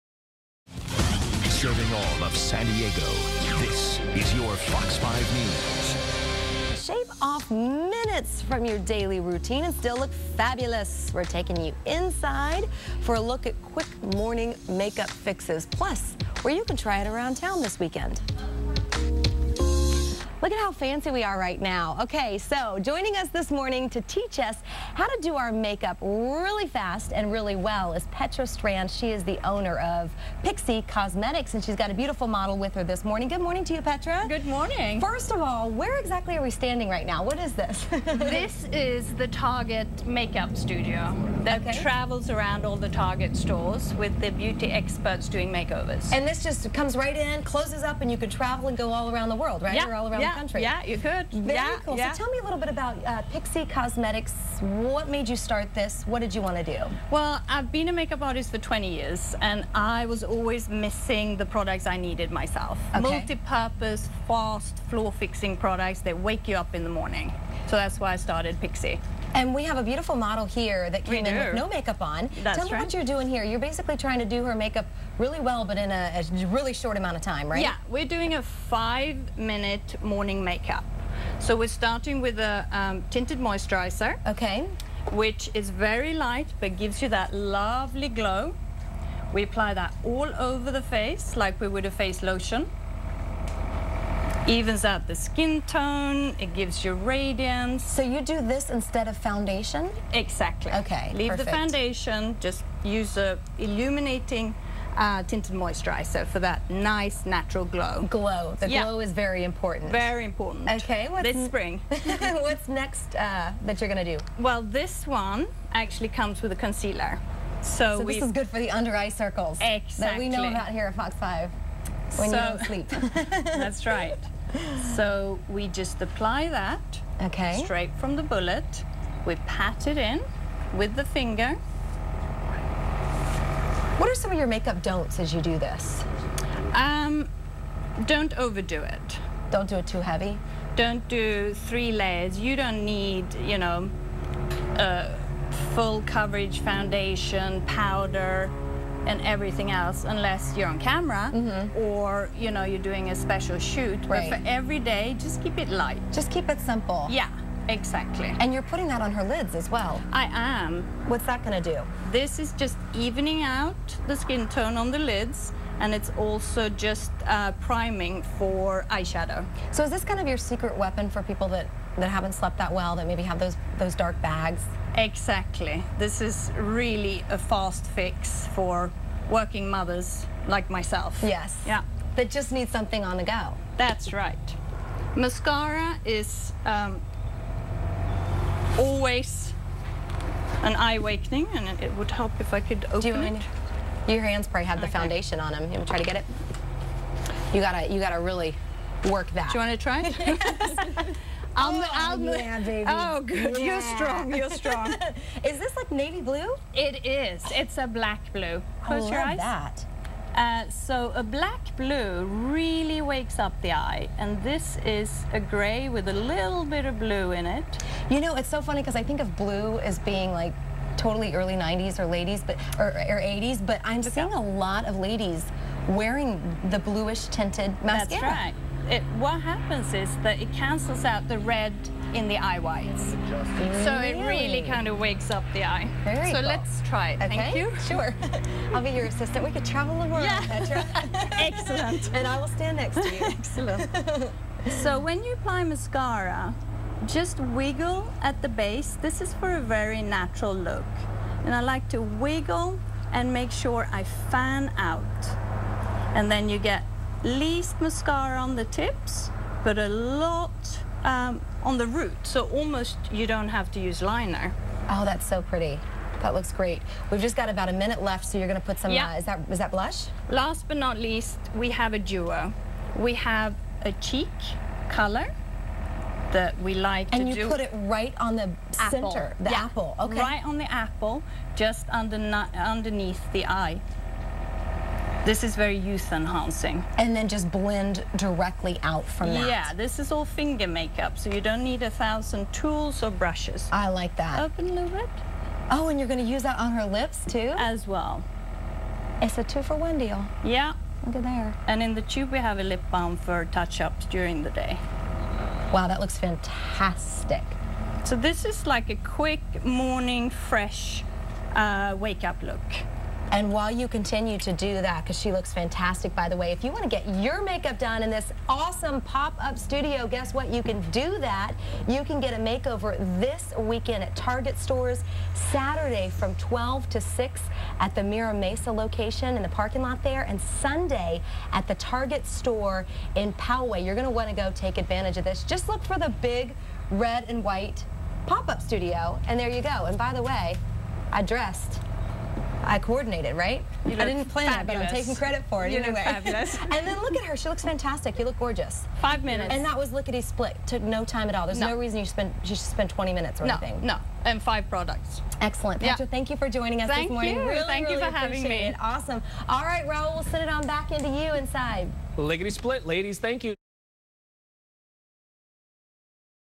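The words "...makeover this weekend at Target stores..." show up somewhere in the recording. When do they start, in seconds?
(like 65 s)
322 s.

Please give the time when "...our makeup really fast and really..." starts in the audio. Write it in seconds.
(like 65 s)
25 s.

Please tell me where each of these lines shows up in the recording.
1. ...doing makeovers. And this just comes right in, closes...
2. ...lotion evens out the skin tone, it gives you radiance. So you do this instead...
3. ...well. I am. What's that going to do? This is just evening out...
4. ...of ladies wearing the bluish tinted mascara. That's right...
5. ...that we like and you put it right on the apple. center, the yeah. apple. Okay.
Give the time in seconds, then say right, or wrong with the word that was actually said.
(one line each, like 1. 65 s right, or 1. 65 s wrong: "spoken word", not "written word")
1. 45 s right
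2. 92 s right
3. 159 s right
4. 224 s right
5. 276 s right.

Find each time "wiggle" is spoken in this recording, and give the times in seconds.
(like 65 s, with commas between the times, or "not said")
247 s, 252 s.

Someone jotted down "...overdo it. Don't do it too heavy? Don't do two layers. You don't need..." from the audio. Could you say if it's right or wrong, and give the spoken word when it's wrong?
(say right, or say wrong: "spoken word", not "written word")
wrong: "three", not "two".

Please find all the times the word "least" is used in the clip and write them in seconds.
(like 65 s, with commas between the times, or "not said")
257 s, 270 s.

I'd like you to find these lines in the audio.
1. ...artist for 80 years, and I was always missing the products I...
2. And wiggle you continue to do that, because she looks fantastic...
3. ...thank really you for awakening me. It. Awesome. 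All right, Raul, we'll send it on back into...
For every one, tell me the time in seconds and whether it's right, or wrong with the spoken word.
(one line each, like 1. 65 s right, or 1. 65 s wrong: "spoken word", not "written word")
1. 58 s wrong: "20", not "80"
2. 313 s wrong: "while", not "wiggle"
3. 357 s wrong: "having", not "awakening".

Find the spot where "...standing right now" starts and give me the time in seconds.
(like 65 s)
36 s.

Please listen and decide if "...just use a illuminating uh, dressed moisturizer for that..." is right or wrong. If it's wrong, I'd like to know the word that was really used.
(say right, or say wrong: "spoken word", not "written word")
wrong: "tinted", not "dressed".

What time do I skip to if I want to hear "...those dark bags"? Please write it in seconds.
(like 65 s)
173 s.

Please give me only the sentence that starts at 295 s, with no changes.
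Oh, and you're going to use that on her lips too?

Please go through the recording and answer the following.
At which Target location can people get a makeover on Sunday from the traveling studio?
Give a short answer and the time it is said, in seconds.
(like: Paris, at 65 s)
Poway, at 333 s.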